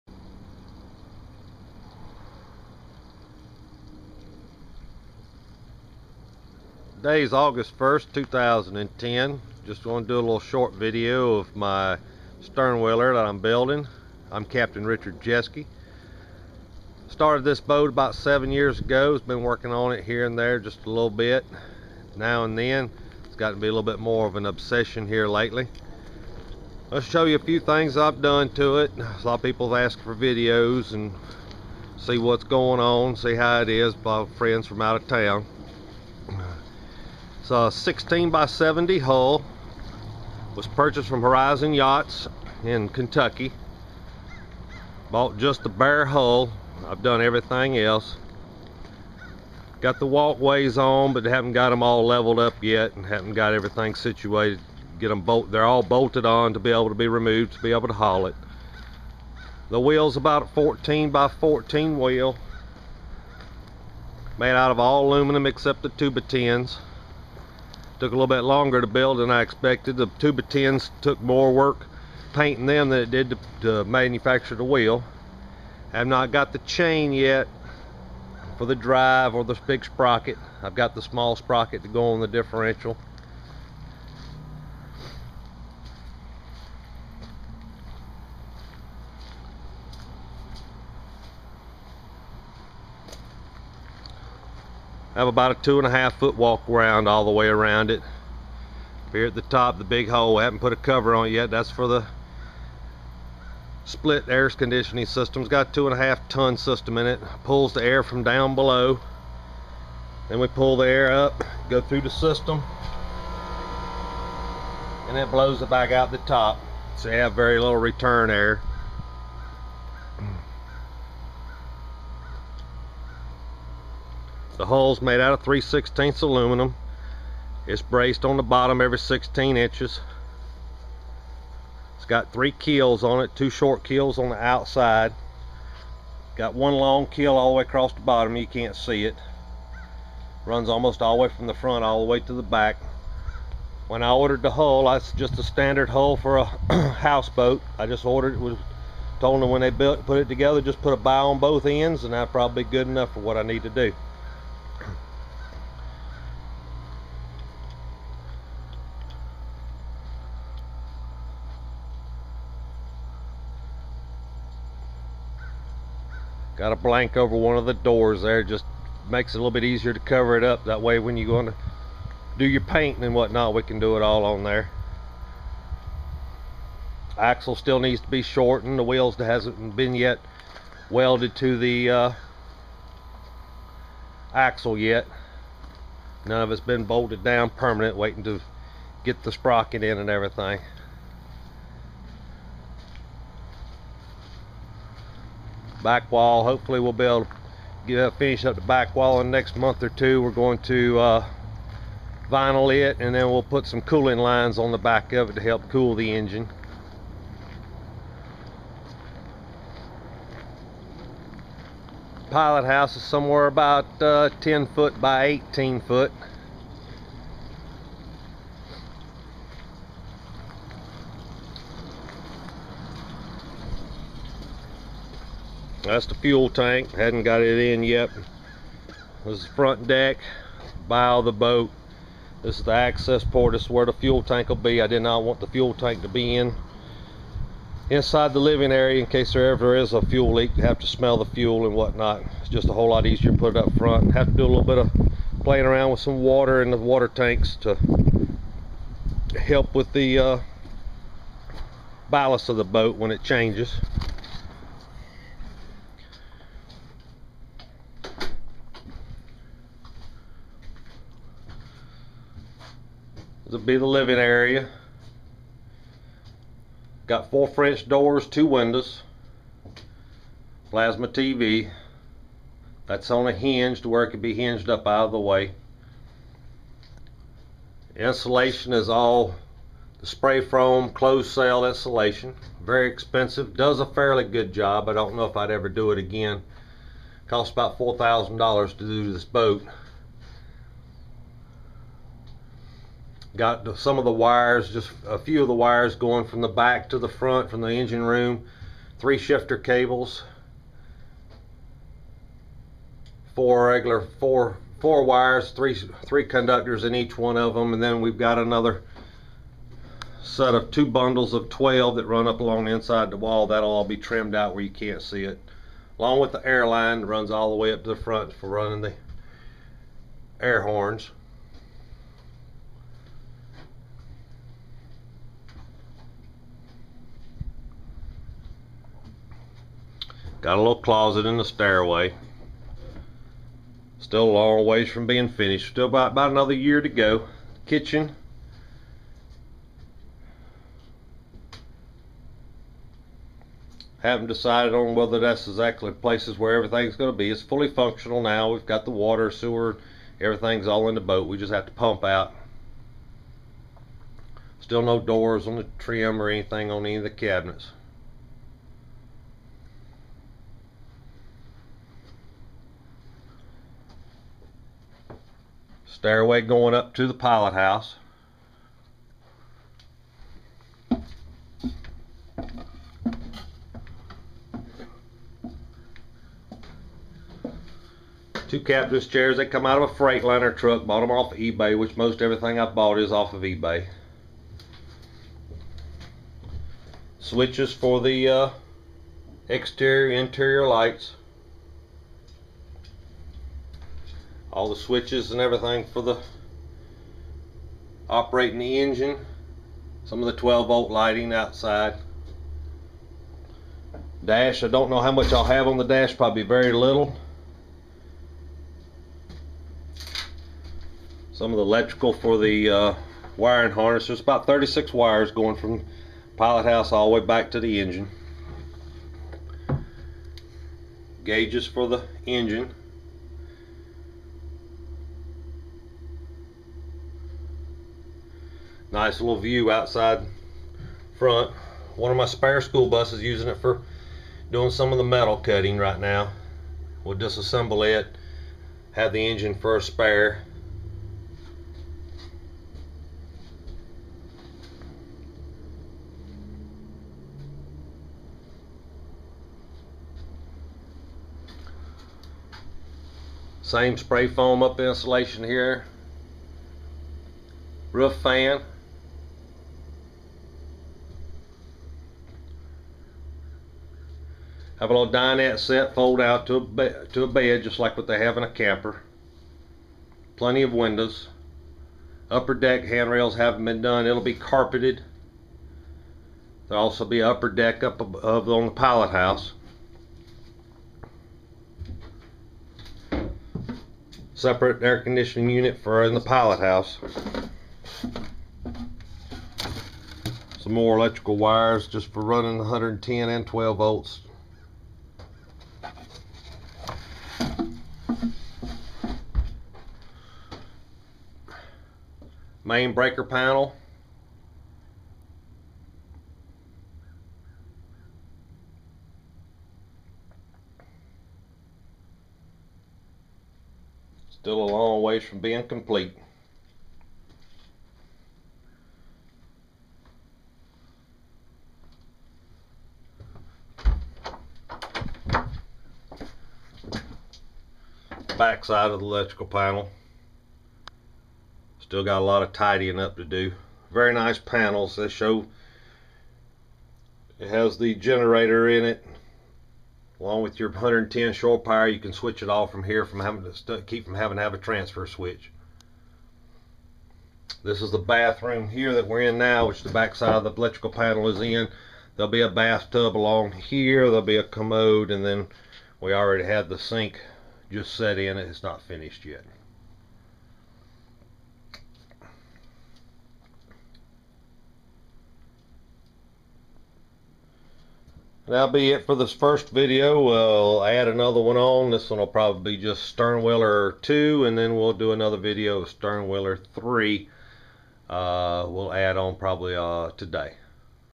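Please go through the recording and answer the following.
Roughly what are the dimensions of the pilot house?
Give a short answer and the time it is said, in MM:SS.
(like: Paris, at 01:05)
10 by 18 feet, at 03:34.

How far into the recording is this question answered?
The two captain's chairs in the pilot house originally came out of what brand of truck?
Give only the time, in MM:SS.
06:19.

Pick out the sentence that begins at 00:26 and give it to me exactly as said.
Let's show you a few things I've done to it.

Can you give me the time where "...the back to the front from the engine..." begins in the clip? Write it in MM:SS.
04:56.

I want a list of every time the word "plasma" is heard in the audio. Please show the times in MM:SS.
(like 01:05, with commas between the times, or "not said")
04:30.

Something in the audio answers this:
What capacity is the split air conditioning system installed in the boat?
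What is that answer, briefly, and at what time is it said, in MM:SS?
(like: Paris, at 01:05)
2.5 ton, at 01:45.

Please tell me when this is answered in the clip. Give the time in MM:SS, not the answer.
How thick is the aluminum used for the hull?
02:05.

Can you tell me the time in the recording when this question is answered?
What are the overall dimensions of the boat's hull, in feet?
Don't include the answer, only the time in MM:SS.
00:37.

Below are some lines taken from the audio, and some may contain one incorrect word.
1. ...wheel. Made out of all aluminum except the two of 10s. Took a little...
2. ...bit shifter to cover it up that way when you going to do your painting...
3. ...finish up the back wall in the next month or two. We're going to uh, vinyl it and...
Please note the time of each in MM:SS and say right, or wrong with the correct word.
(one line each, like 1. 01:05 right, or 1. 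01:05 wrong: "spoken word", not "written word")
1. 01:01 right
2. 02:49 wrong: "easier", not "shifter"
3. 03:18 right.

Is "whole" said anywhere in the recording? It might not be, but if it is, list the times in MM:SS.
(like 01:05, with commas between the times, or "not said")
04:02.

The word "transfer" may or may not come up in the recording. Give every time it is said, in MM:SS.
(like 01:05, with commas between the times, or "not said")
09:04.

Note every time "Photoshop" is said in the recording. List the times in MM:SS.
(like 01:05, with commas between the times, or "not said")
not said.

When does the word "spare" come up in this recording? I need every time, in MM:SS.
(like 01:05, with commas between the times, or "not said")
07:12, 07:19.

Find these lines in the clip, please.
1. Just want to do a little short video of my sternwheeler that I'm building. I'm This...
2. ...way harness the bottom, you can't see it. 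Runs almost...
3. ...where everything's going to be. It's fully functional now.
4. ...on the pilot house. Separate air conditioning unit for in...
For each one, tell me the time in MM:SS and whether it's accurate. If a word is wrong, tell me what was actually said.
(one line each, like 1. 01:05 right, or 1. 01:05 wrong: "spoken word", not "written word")
1. 00:09 wrong: "Captain", not "This"
2. 02:17 wrong: "across", not "harness"
3. 05:46 right
4. 07:58 right.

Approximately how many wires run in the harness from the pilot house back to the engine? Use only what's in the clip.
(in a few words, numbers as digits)
36.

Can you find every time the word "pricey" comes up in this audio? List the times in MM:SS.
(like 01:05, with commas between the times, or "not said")
not said.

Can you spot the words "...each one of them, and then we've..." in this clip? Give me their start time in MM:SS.
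05:06.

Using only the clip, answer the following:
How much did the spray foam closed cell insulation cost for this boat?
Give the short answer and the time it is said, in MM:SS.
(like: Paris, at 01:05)
$4,000, at 04:47.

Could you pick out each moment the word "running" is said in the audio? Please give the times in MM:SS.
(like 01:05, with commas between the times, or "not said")
05:18, 08:12.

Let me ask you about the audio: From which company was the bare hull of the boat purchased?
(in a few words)
Horizon Yachts.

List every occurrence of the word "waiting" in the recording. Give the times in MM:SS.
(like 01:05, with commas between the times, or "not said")
03:07.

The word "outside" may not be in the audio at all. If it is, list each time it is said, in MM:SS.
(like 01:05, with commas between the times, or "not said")
02:14, 06:41, 07:09.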